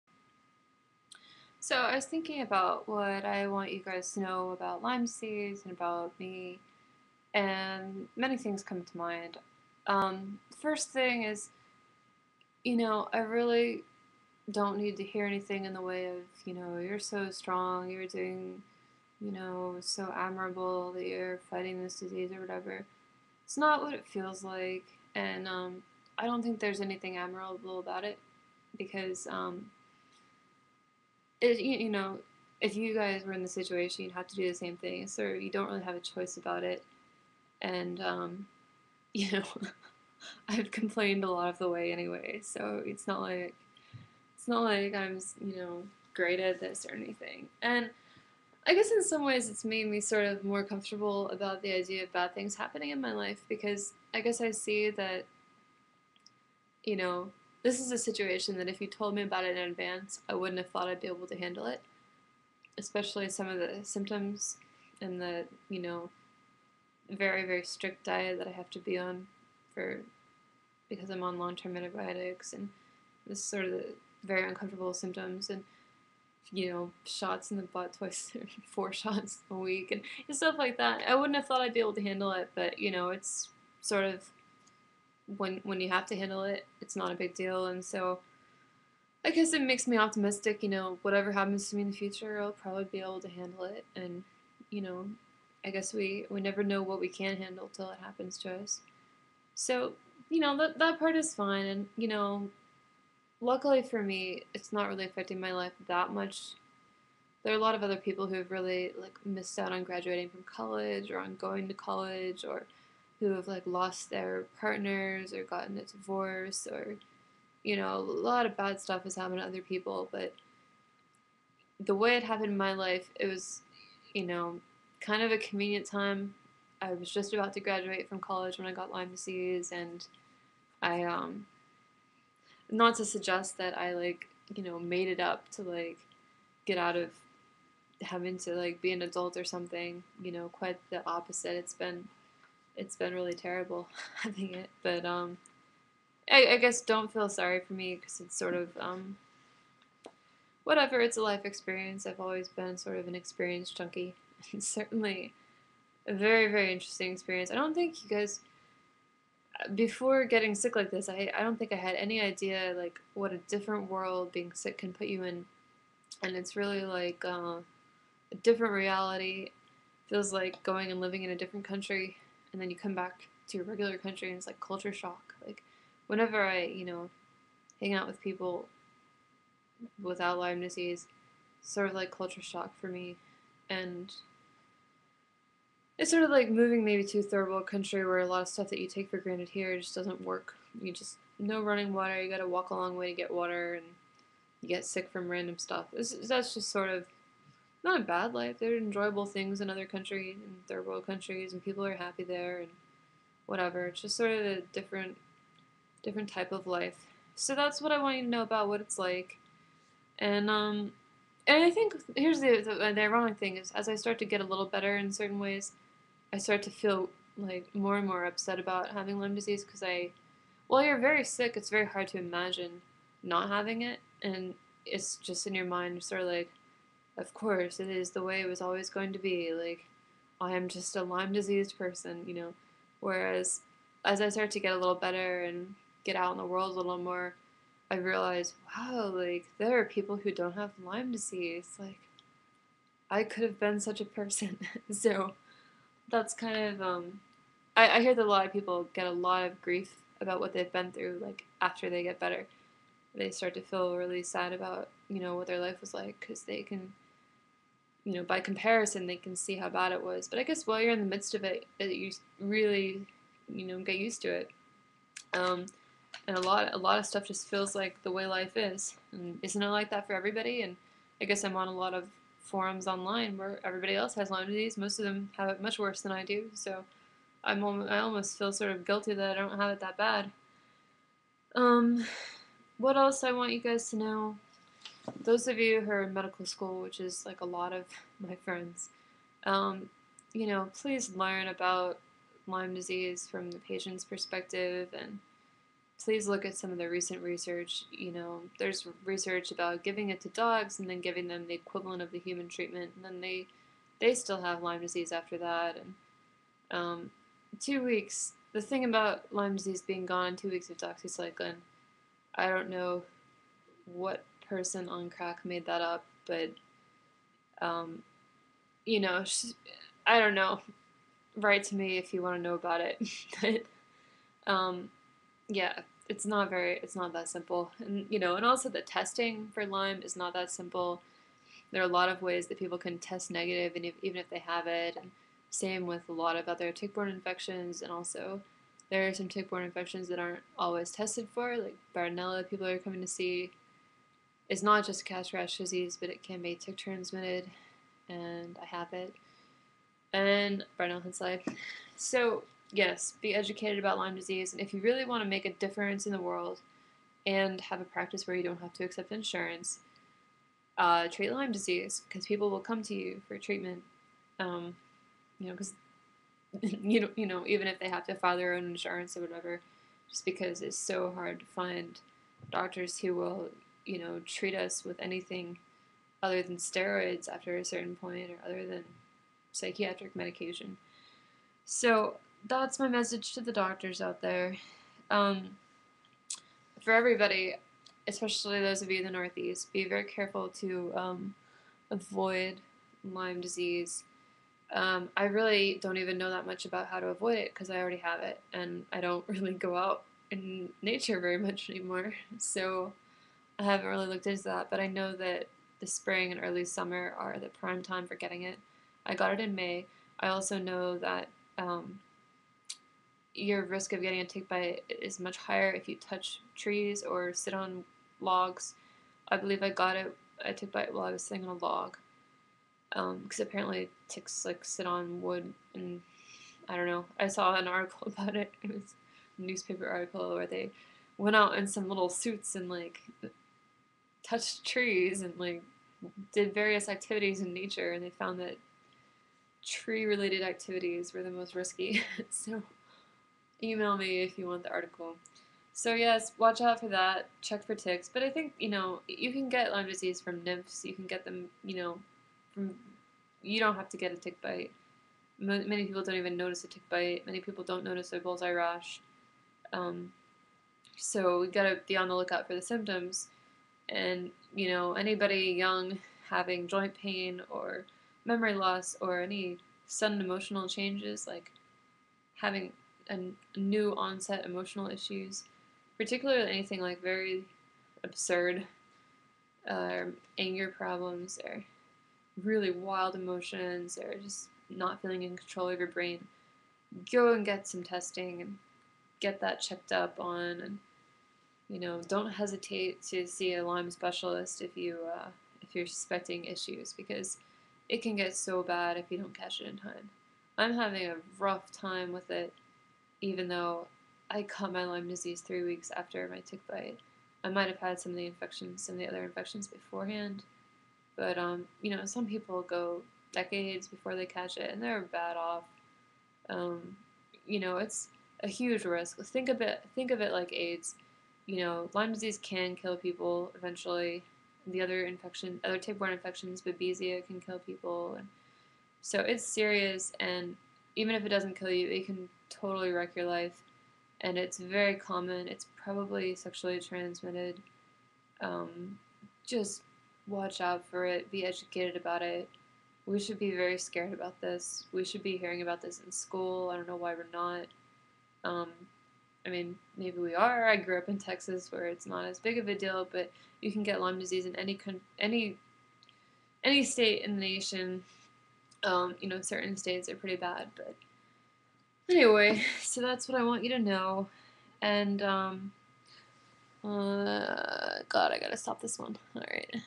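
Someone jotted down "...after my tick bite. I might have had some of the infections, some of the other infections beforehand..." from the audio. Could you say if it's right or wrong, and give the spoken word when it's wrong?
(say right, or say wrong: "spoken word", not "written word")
right.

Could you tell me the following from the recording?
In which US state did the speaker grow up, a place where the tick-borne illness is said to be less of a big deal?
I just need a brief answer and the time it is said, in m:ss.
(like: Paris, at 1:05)
Texas, at 9:11.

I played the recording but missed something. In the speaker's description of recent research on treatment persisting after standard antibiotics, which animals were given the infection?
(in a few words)
dogs.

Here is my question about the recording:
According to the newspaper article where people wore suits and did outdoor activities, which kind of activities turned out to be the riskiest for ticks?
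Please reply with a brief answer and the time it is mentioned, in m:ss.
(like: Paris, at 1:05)
tree related activities, at 7:19.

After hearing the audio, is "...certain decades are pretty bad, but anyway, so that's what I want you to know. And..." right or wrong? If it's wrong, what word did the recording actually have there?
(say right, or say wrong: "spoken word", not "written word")
wrong: "states", not "decades".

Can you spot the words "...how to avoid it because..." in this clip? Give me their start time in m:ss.
6:36.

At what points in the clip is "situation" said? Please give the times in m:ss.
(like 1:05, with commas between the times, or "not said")
0:33, 0:57.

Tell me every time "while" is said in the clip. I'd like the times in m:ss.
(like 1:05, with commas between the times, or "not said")
3:40, 4:20, 7:00.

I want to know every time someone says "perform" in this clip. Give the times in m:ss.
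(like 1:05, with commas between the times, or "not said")
not said.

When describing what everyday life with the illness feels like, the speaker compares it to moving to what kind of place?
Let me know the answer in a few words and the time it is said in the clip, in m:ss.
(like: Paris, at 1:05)
a third world country, at 3:07.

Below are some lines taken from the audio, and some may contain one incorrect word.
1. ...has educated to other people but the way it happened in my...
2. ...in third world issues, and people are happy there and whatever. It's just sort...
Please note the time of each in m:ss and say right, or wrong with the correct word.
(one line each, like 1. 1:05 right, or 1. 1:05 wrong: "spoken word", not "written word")
1. 1:59 wrong: "happened", not "educated"
2. 3:20 wrong: "countries", not "issues".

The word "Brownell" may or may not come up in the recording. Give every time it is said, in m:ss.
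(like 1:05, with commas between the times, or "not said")
5:50.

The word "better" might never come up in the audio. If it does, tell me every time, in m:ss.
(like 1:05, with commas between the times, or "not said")
3:34, 3:54, 4:12.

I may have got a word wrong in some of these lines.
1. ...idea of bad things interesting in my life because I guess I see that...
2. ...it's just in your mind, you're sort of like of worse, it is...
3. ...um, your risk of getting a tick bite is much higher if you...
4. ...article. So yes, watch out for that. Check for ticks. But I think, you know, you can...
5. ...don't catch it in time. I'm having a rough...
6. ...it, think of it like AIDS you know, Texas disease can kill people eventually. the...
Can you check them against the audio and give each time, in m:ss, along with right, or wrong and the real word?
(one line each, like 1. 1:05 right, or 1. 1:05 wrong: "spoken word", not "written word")
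1. 0:51 wrong: "happening", not "interesting"
2. 3:44 wrong: "course", not "worse"
3. 6:51 right
4. 7:24 right
5. 8:19 right
6. 8:39 wrong: "Lyme", not "Texas".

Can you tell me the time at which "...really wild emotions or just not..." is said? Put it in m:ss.
8:02.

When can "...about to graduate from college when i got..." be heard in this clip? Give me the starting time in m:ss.
2:07.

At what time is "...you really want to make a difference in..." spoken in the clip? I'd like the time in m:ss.
5:54.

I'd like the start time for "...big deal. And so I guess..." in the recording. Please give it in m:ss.
1:27.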